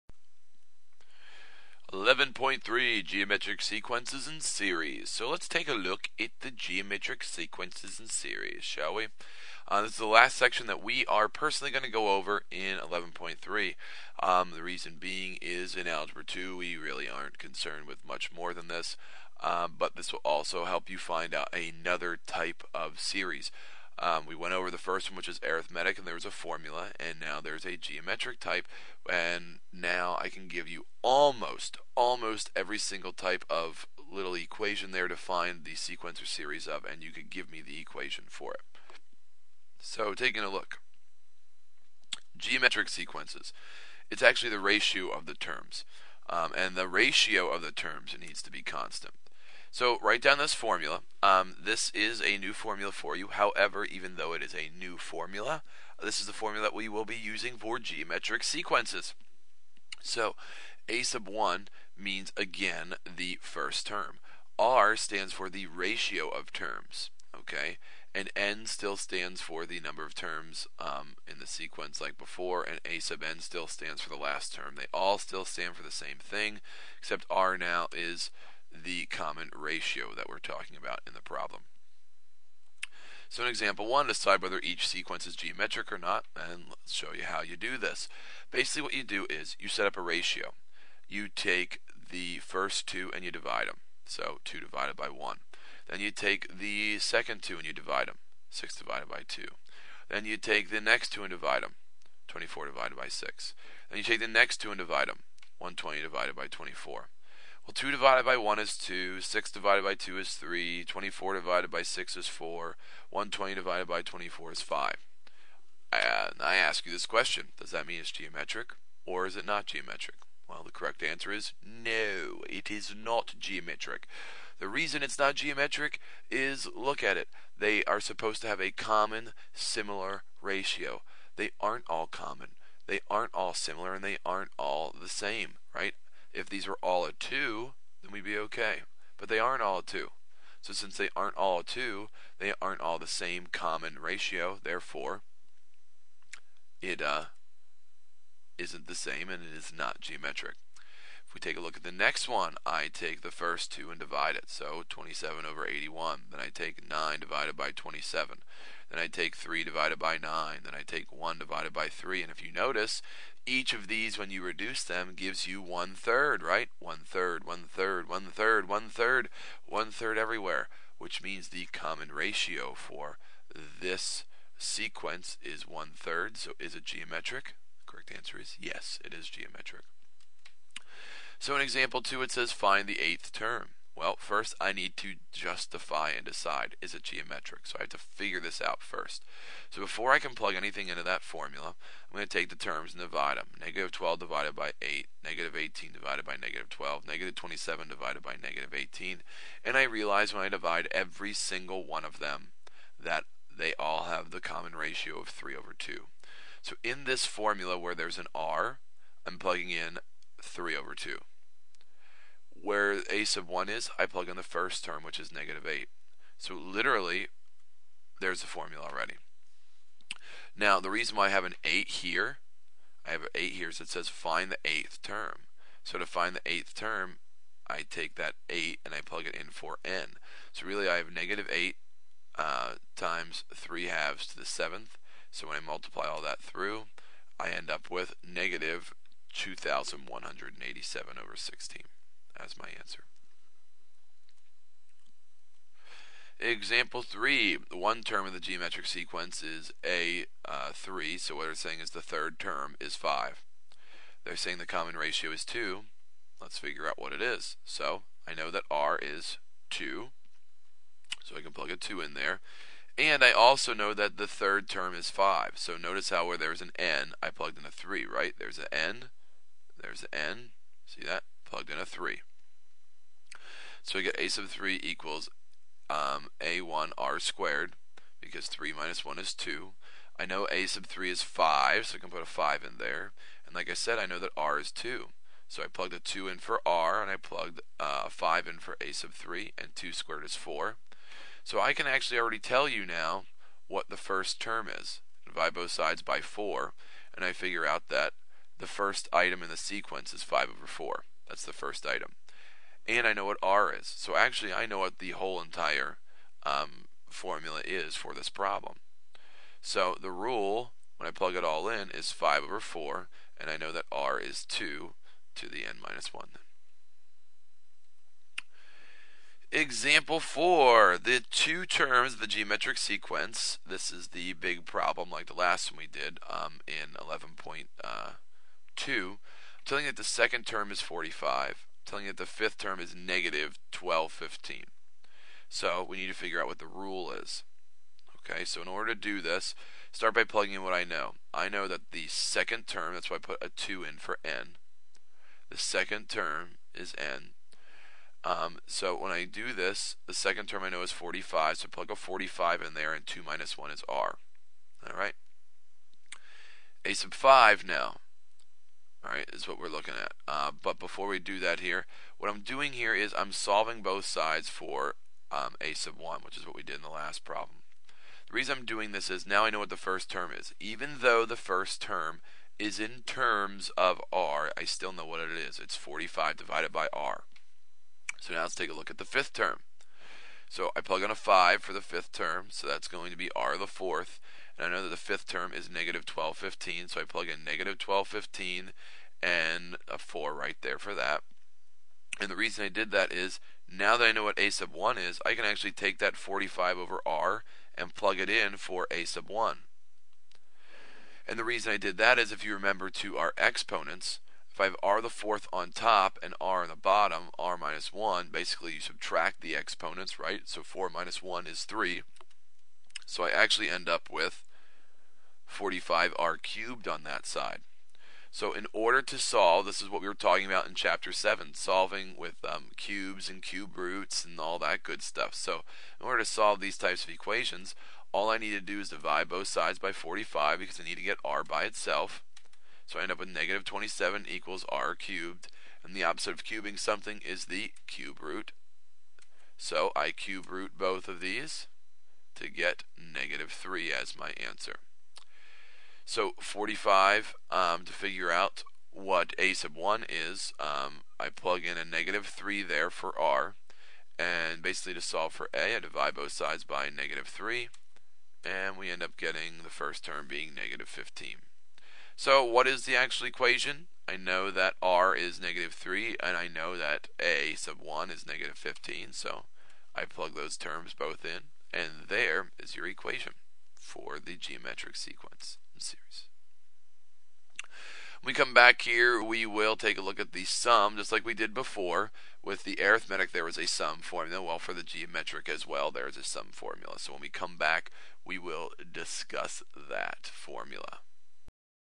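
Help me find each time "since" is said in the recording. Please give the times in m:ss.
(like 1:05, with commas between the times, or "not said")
2:20.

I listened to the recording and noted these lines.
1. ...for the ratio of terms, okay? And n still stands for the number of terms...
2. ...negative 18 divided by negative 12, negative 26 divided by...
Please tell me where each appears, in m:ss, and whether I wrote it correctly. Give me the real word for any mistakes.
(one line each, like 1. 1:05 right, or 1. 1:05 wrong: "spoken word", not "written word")
1. 1:05 right
2. 3:15 wrong: "27", not "26".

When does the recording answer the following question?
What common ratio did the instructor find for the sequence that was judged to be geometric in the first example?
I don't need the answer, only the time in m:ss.
2:51.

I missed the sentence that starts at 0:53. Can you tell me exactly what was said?
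However, even though it is a new formula, this is the formula that we will be using for geometric sequences.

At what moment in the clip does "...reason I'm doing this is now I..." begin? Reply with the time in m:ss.
6:08.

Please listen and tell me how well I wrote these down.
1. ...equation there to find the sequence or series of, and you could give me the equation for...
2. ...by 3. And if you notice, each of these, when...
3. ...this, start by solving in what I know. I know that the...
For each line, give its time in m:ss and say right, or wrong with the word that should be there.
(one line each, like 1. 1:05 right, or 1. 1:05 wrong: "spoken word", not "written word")
1. 0:34 right
2. 2:41 right
3. 5:39 wrong: "plugging", not "solving".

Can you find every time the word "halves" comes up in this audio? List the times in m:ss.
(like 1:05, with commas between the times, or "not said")
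3:53.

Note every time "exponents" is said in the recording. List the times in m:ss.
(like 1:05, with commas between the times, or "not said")
6:43, 6:49.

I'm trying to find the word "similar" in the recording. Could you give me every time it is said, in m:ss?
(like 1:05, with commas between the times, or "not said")
2:09, 2:13.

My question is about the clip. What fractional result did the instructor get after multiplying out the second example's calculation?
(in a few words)
-2187/16.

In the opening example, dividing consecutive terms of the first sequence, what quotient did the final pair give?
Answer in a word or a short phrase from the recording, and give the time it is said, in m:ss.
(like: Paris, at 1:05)
5, at 1:53.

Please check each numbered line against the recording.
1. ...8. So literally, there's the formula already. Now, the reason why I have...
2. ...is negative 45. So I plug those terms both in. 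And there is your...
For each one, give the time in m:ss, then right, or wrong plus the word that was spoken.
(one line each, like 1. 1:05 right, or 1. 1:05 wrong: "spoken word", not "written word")
1. 3:35 right
2. 7:48 wrong: "15", not "45".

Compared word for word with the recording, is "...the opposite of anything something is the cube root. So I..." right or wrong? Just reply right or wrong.
wrong.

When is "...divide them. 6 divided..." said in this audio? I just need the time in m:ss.
1:37.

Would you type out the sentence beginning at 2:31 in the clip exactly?
If we take a look at the next one, I take the first 2 and divide it.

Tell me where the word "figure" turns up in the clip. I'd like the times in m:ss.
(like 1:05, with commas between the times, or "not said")
3:07, 4:16, 4:57, 5:36, 7:27.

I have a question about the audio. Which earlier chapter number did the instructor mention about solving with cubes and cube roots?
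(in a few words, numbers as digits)
7.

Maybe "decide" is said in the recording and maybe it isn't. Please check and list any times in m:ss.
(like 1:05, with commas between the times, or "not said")
1:24, 3:06.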